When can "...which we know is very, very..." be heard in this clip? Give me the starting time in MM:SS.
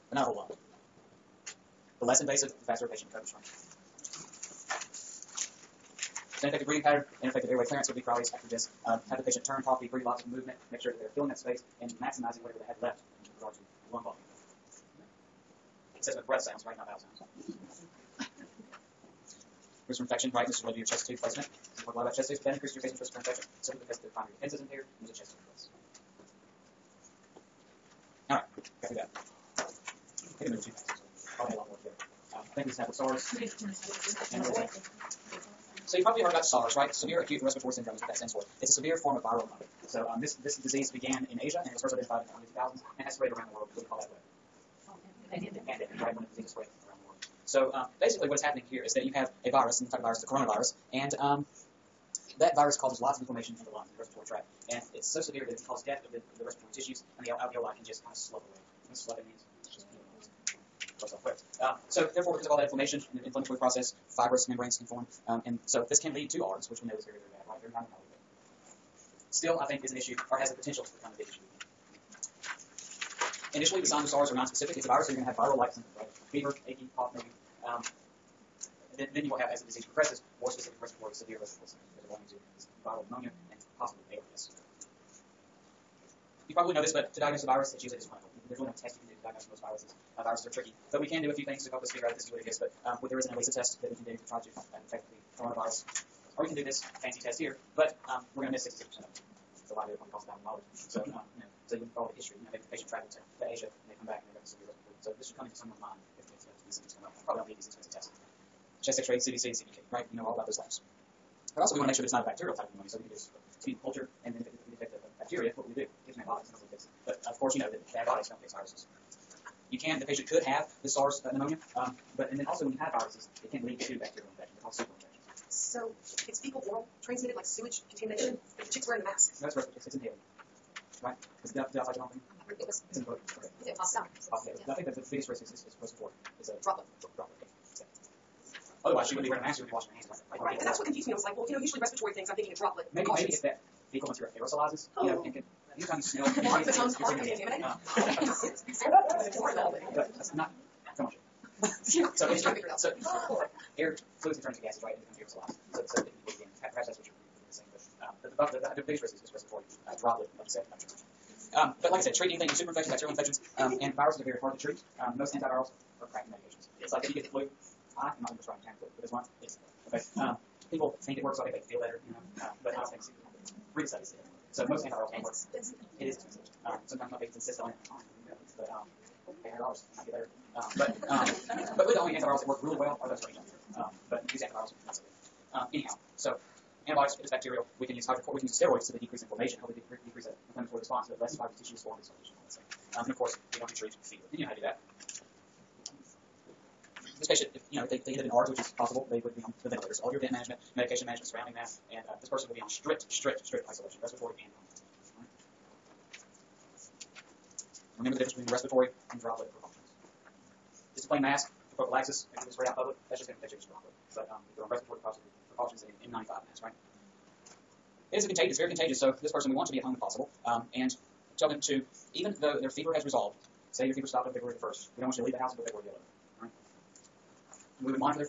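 01:06.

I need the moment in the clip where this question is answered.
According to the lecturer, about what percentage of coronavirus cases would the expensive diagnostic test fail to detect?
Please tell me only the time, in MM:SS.
01:38.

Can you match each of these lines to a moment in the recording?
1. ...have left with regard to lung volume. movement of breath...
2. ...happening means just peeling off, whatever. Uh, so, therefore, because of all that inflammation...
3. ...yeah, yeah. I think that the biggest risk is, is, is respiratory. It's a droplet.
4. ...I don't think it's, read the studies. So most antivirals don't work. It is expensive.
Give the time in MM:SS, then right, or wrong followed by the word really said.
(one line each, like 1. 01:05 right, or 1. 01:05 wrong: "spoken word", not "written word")
1. 00:12 wrong: "assessment", not "movement"
2. 00:58 wrong: "sloughing", not "happening"
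3. 02:14 right
4. 02:52 right.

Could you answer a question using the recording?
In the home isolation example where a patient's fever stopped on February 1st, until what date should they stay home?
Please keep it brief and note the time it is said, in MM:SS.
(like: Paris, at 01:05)
February 11, at 03:45.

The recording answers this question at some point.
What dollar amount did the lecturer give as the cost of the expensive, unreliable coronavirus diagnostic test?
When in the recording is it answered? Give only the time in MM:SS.
01:40.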